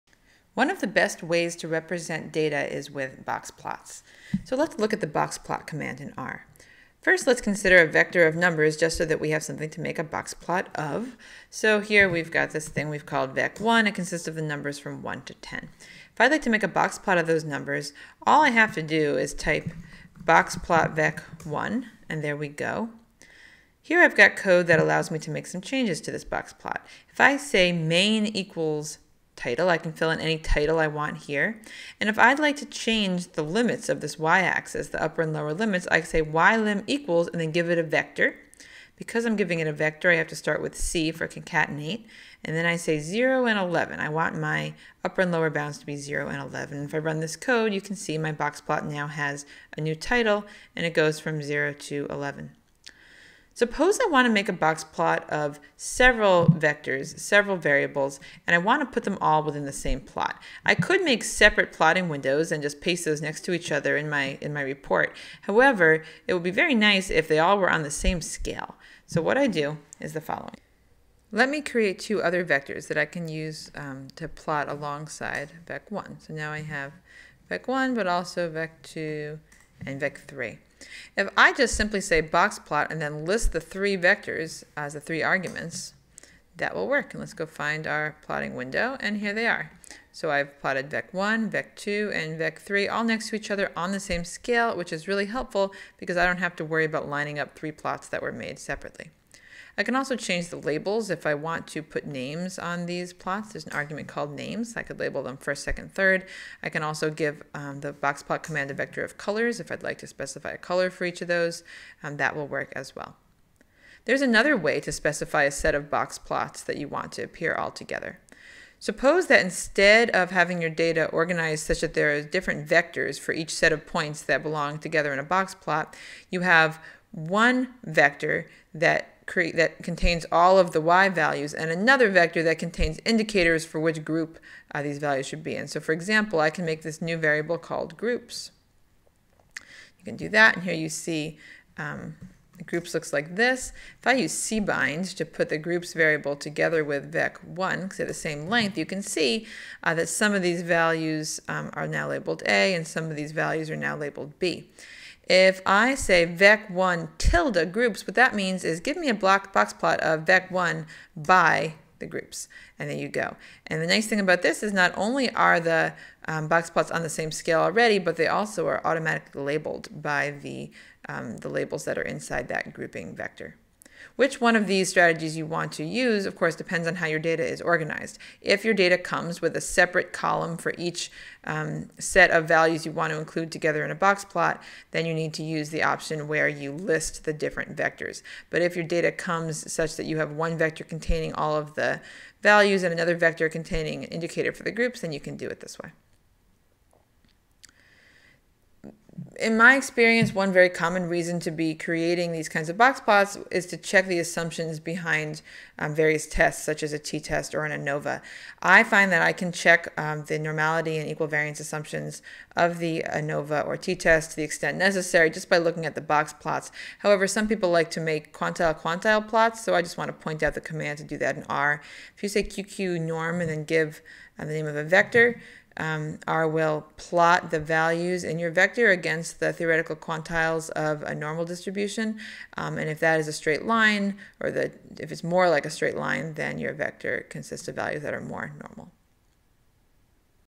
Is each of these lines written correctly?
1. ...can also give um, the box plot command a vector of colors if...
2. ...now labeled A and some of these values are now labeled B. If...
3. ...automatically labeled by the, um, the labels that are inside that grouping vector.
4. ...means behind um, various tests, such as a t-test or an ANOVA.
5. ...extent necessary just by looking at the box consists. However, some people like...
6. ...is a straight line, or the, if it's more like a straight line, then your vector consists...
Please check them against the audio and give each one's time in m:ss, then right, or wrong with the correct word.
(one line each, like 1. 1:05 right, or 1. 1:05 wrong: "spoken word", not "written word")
1. 1:46 right
2. 2:31 right
3. 2:48 right
4. 3:24 wrong: "assumptions", not "means"
5. 3:34 wrong: "plots", not "consists"
6. 3:53 right.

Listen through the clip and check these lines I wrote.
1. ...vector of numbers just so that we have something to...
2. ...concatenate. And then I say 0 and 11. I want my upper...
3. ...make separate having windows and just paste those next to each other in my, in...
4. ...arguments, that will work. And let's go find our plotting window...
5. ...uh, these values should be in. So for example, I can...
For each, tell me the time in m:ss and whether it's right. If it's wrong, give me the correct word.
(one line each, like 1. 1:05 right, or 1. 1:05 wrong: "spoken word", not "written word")
1. 0:07 right
2. 0:41 right
3. 1:01 wrong: "plotting", not "having"
4. 1:25 right
5. 2:14 right.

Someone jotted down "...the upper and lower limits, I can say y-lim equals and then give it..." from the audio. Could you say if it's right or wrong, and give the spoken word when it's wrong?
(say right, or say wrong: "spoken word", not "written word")
right.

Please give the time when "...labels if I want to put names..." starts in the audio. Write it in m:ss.
1:40.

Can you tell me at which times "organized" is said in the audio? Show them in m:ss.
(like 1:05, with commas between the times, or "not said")
2:01, 2:57.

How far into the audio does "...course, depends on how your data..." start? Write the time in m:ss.
2:56.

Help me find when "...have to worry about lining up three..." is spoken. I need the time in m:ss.
1:36.